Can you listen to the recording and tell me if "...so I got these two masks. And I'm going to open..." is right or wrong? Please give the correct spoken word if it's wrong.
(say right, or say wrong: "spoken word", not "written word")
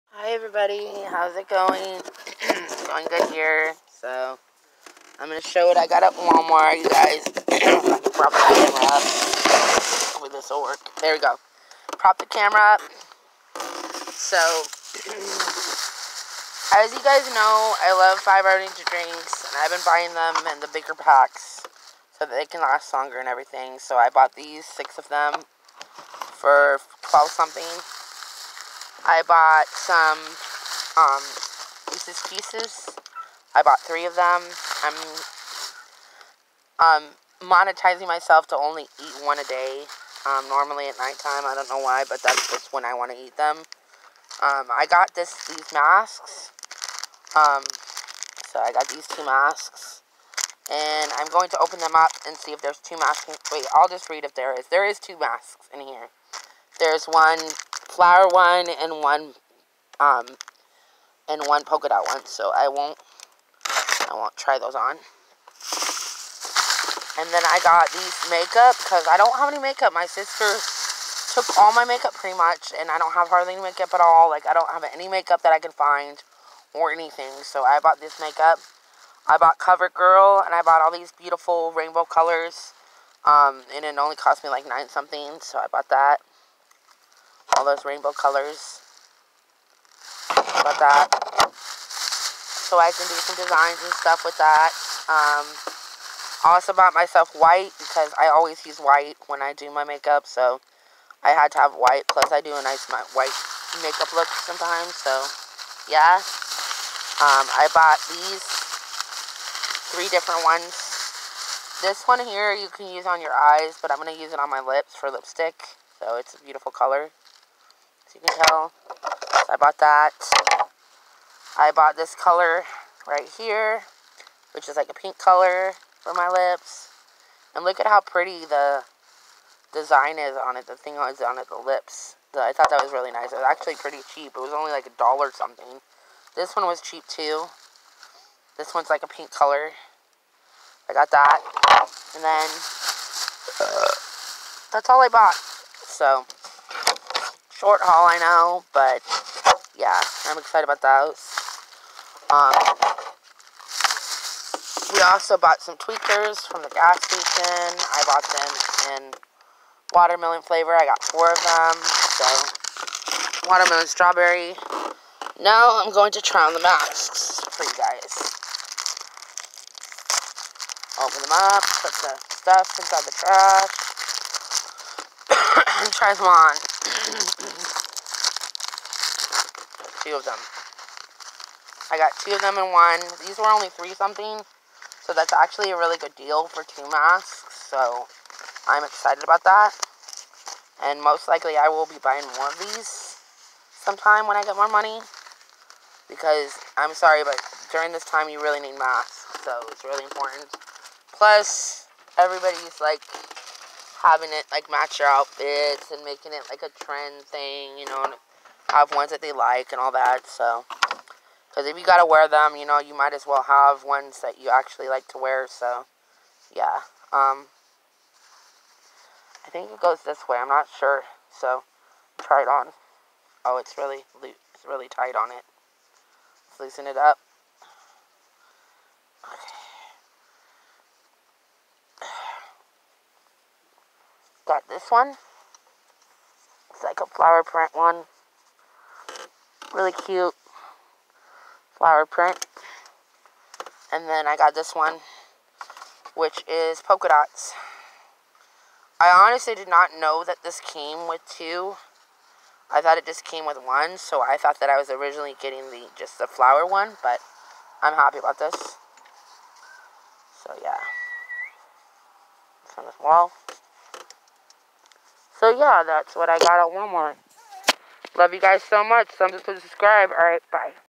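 right.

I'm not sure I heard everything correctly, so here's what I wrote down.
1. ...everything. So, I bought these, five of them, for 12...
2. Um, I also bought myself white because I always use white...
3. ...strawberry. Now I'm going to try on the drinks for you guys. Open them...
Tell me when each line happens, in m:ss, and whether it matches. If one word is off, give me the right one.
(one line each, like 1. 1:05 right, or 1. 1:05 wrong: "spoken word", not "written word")
1. 0:23 wrong: "six", not "five"
2. 1:35 right
3. 2:43 wrong: "masks", not "drinks".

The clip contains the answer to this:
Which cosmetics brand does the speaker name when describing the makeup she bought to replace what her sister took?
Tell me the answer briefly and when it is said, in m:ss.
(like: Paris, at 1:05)
CoverGirl, at 1:19.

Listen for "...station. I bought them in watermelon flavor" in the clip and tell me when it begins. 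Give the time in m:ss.
2:37.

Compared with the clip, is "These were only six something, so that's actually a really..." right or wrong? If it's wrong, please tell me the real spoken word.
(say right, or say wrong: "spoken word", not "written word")
wrong: "three", not "six".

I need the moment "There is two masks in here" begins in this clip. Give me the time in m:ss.
0:54.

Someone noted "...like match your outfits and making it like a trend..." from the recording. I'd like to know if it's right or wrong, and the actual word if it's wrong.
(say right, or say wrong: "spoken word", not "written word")
right.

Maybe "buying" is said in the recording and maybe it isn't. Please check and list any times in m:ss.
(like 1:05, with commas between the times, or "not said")
0:19, 3:12.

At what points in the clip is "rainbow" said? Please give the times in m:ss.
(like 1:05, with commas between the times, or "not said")
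1:21, 1:27.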